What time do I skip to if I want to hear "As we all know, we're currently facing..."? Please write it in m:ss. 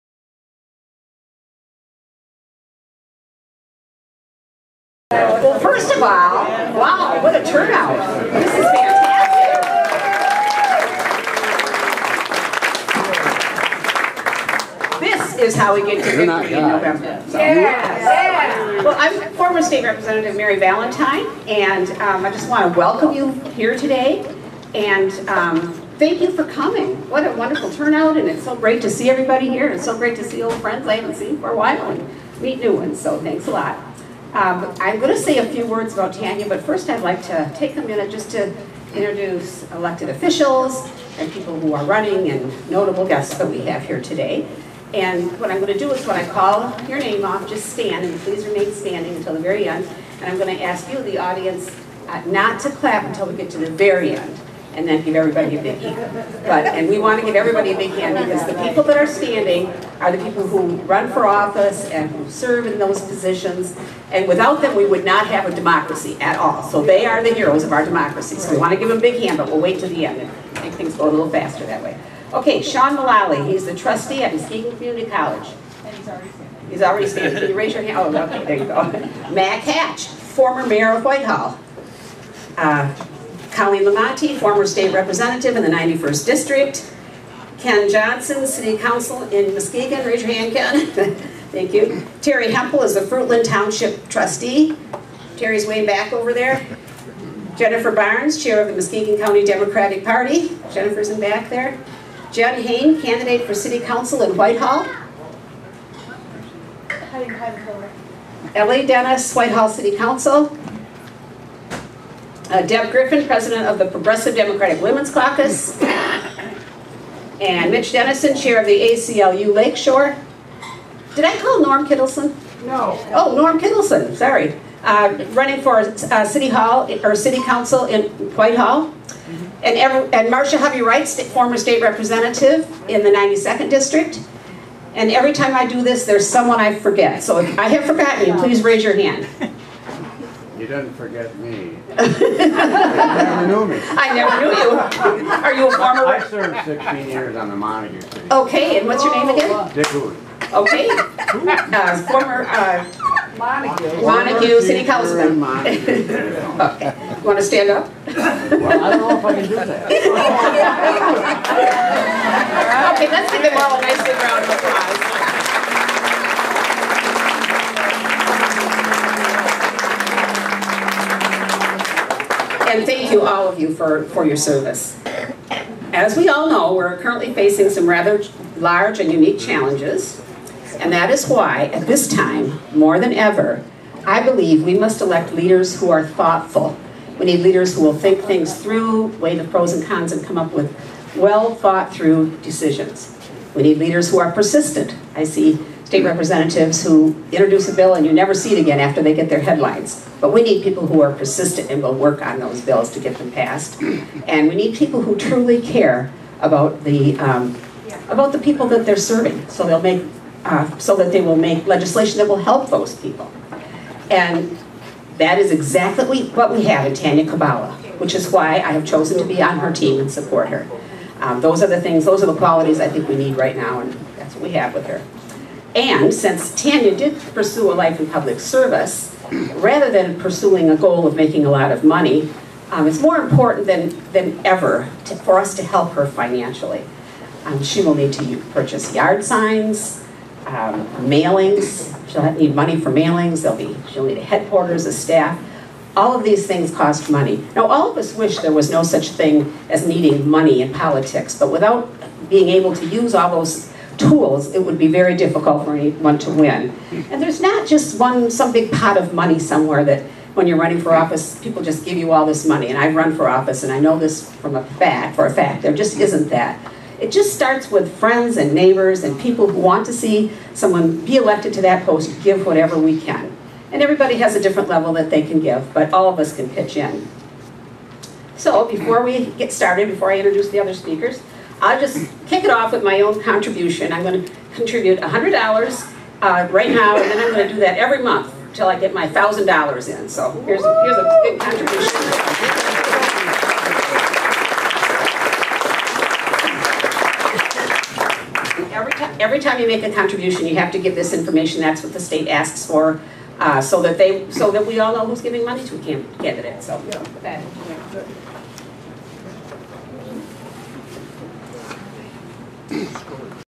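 2:55.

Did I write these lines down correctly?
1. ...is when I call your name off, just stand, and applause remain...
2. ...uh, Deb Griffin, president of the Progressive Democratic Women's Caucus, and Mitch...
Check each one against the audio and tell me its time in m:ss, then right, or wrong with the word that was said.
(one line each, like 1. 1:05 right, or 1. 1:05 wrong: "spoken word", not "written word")
1. 0:45 wrong: "please", not "applause"
2. 1:52 right.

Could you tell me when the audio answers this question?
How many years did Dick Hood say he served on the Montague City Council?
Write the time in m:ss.
2:26.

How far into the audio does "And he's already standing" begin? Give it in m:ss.
1:15.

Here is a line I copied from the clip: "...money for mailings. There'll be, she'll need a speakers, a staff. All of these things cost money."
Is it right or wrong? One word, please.
wrong.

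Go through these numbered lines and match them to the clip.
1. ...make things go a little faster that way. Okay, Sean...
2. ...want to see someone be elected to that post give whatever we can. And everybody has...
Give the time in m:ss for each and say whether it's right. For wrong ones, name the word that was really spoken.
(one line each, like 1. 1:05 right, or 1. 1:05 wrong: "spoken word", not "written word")
1. 1:10 right
2. 4:29 right.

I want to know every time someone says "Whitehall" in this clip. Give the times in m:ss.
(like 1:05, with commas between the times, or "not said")
1:21, 1:44, 1:49, 2:08.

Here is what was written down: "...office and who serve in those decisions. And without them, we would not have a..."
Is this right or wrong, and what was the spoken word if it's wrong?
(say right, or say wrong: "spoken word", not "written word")
wrong: "positions", not "decisions".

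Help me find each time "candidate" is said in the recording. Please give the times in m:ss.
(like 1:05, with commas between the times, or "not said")
1:42, 5:05.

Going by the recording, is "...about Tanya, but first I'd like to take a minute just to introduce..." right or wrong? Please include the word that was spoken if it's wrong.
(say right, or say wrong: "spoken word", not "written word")
right.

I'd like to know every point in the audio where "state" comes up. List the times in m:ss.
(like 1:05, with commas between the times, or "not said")
0:19, 1:24, 2:11, 3:15, 5:01.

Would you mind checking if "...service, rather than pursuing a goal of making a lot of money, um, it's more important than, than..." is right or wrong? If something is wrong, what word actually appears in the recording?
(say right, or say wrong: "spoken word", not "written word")
right.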